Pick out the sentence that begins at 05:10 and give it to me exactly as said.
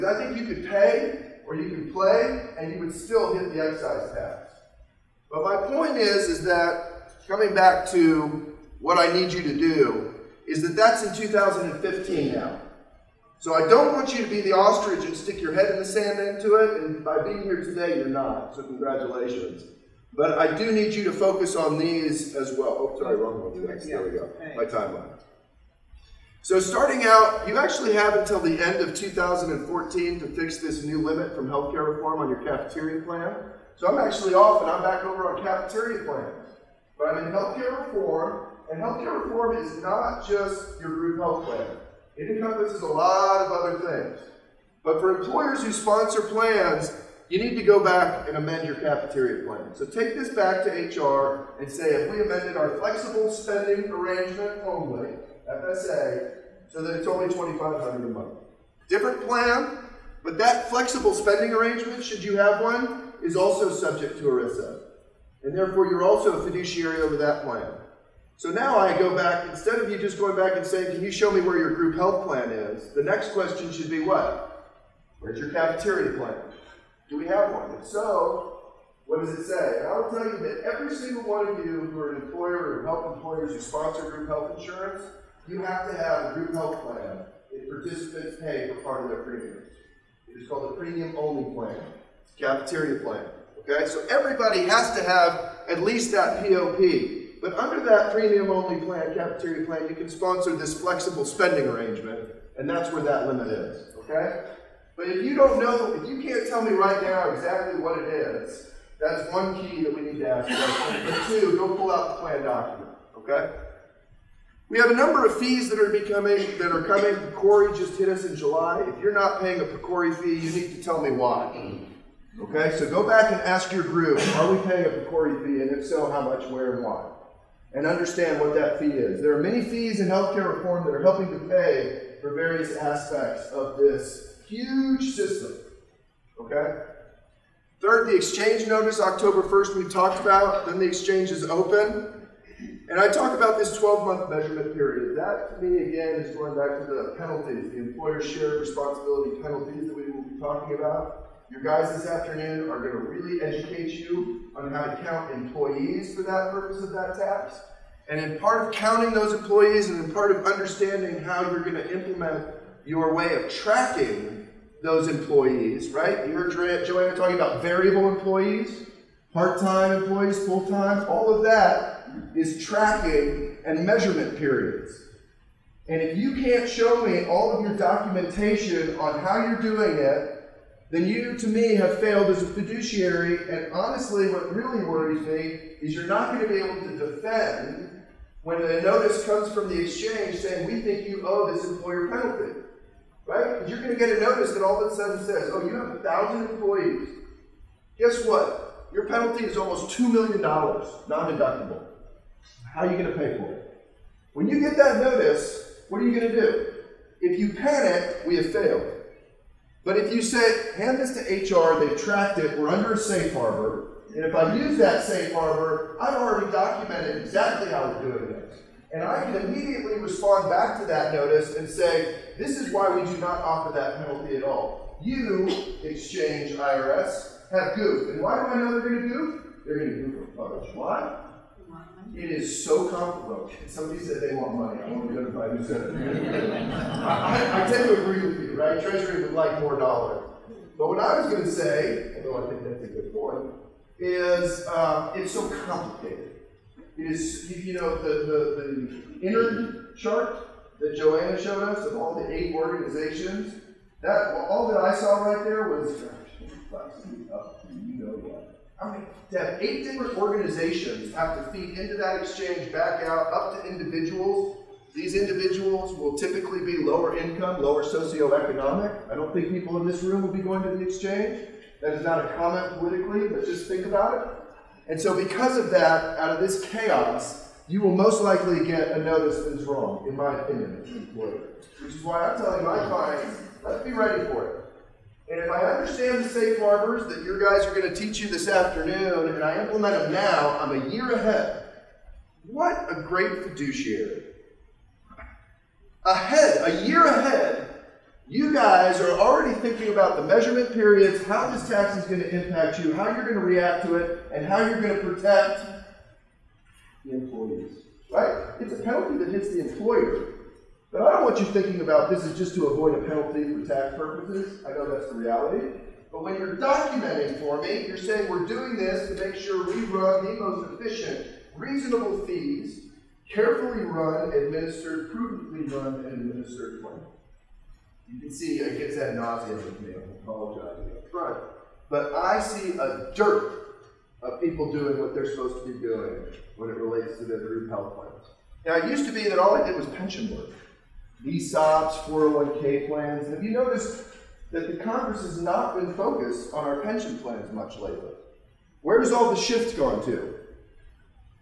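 But I don't want you thinking about this is just to avoid a penalty for tax purposes.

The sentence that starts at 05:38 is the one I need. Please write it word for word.
Now, it used to be that all I did was pension work ESOPs, 401k plans.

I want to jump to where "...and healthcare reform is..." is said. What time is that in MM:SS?
00:38.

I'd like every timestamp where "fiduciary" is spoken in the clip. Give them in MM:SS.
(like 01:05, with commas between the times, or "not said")
01:06, 03:02, 04:53.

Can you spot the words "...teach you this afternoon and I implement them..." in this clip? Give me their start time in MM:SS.
04:47.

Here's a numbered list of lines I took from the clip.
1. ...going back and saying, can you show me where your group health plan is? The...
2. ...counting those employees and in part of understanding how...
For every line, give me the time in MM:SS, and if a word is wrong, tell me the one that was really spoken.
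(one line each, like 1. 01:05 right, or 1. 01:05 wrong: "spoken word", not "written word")
1. 01:10 right
2. 02:38 right.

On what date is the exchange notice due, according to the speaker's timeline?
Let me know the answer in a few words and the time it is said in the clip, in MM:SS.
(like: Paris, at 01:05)
October 1, at 02:18.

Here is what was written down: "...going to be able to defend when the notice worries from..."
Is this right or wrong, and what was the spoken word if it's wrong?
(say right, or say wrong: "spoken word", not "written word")
wrong: "comes", not "worries".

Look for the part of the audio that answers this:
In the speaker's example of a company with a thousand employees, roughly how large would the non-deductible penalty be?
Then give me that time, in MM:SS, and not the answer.
03:19.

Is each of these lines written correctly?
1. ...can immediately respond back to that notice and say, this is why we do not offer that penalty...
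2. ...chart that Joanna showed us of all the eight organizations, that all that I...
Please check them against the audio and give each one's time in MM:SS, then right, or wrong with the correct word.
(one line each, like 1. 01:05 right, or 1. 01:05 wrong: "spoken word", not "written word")
1. 03:39 right
2. 04:09 right.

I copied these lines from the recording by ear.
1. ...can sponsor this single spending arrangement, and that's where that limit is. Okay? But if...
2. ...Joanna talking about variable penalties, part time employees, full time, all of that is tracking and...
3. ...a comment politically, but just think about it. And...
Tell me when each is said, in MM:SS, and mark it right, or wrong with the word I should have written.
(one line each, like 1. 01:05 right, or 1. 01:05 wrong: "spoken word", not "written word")
1. 01:39 wrong: "flexible", not "single"
2. 02:46 wrong: "employees", not "penalties"
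3. 04:32 right.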